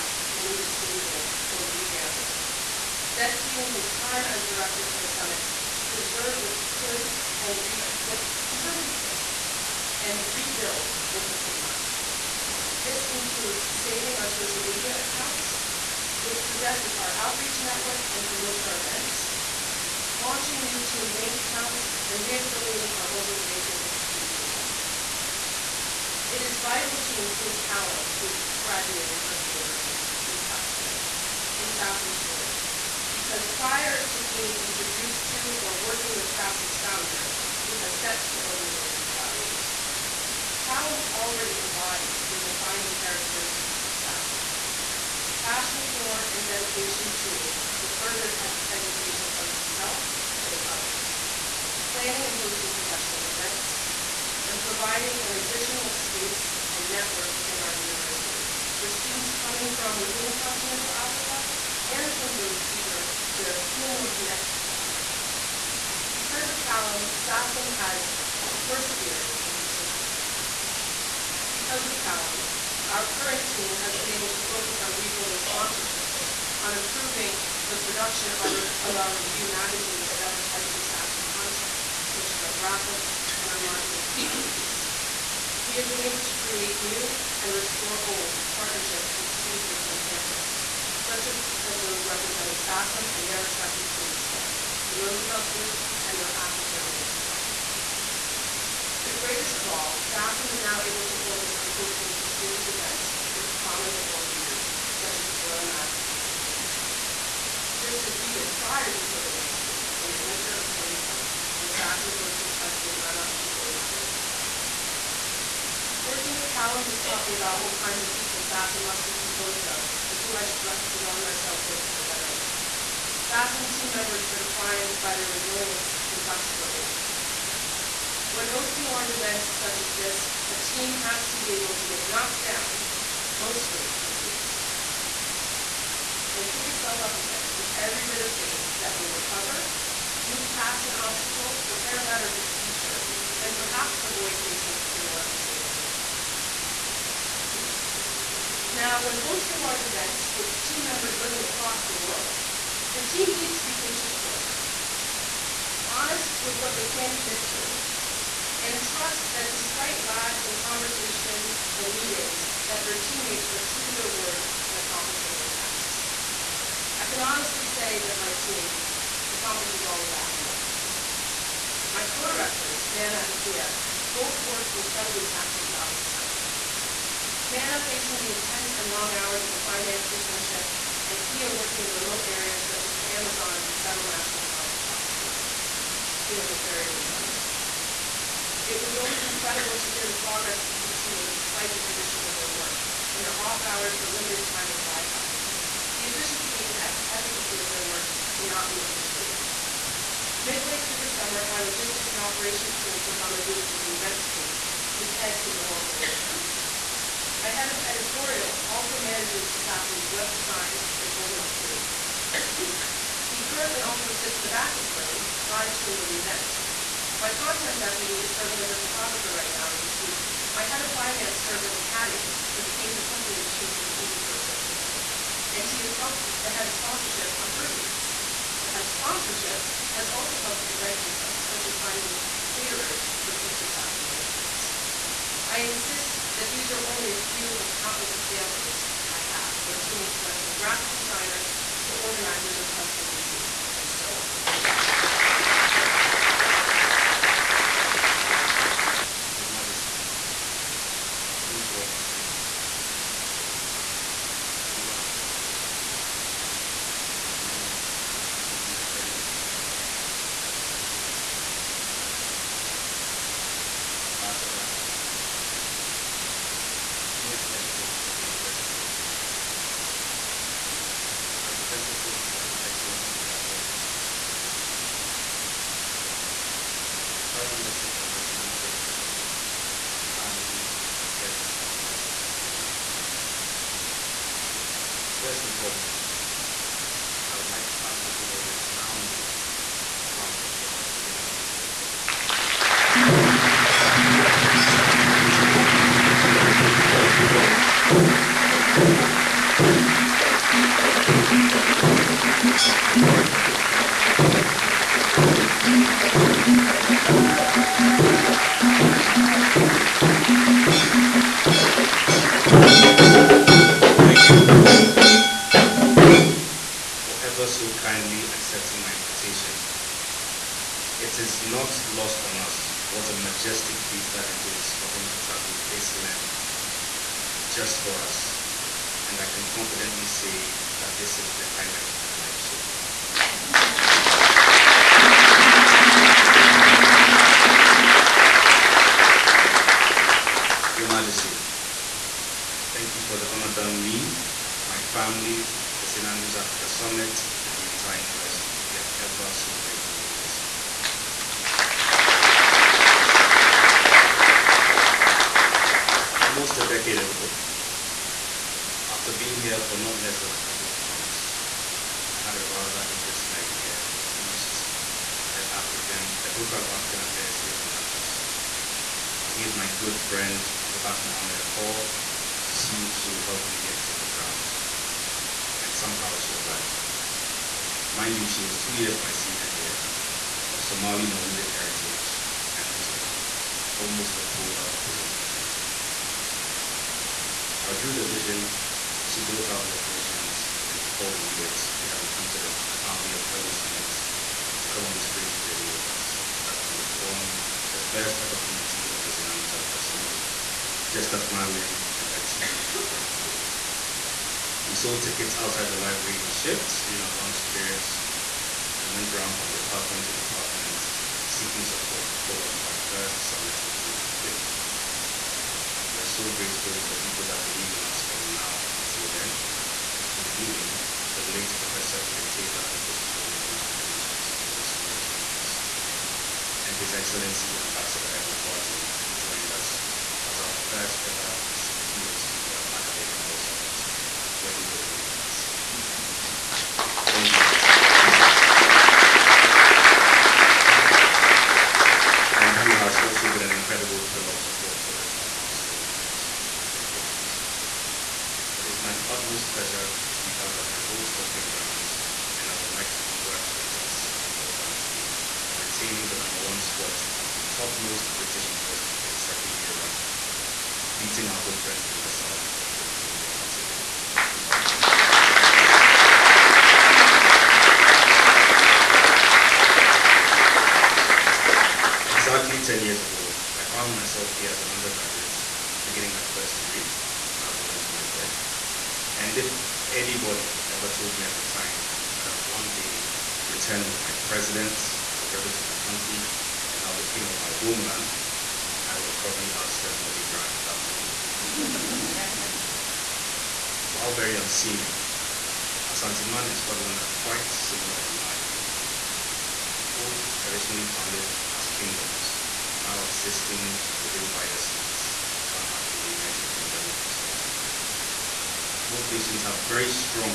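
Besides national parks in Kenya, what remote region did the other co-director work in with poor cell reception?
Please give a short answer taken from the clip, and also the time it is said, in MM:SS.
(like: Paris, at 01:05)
the Amazon, at 03:03.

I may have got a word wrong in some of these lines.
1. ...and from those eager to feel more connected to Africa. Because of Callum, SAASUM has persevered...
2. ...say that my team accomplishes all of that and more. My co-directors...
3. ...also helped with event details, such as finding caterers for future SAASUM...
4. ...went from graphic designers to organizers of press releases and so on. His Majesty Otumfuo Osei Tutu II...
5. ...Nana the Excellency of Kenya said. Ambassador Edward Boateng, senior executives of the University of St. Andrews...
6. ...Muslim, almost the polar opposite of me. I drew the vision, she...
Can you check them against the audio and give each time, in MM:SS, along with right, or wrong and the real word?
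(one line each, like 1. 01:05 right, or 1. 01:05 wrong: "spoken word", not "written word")
1. 01:01 right
2. 02:47 right
3. 03:50 right
4. 04:00 right
5. 04:20 wrong: "Chidomine", not "Excellency"
6. 06:22 right.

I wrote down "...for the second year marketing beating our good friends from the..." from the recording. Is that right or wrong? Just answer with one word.
wrong.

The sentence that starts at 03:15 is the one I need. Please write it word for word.
The efficiency and efficacy of their work cannot be overstated.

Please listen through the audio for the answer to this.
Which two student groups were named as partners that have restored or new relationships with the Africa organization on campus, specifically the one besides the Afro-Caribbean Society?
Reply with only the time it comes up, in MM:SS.
01:34.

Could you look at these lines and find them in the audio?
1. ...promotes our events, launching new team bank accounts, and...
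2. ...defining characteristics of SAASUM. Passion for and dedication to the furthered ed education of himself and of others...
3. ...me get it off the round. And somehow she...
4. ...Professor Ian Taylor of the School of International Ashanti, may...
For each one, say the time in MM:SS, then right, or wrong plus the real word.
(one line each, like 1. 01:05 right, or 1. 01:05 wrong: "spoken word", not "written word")
1. 00:18 right
2. 00:42 right
3. 06:13 wrong: "ground", not "round"
4. 07:01 wrong: "Relations", not "Ashanti".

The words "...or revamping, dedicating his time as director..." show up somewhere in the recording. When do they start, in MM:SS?
00:01.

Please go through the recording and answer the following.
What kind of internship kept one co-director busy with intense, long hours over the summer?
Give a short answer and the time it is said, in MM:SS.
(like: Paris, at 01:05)
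finance internship, at 02:59.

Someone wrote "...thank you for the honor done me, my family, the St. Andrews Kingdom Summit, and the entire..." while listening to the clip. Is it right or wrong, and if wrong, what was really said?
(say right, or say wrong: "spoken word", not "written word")
wrong: "Africa", not "Kingdom".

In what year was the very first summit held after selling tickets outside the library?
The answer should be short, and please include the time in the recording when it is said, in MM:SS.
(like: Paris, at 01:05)
2015, at 06:53.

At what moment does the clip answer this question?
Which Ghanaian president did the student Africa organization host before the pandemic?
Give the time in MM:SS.
01:52.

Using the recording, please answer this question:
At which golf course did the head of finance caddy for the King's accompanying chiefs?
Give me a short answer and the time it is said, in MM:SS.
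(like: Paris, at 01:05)
Eden course, at 03:43.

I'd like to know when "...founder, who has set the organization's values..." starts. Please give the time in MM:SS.
00:36.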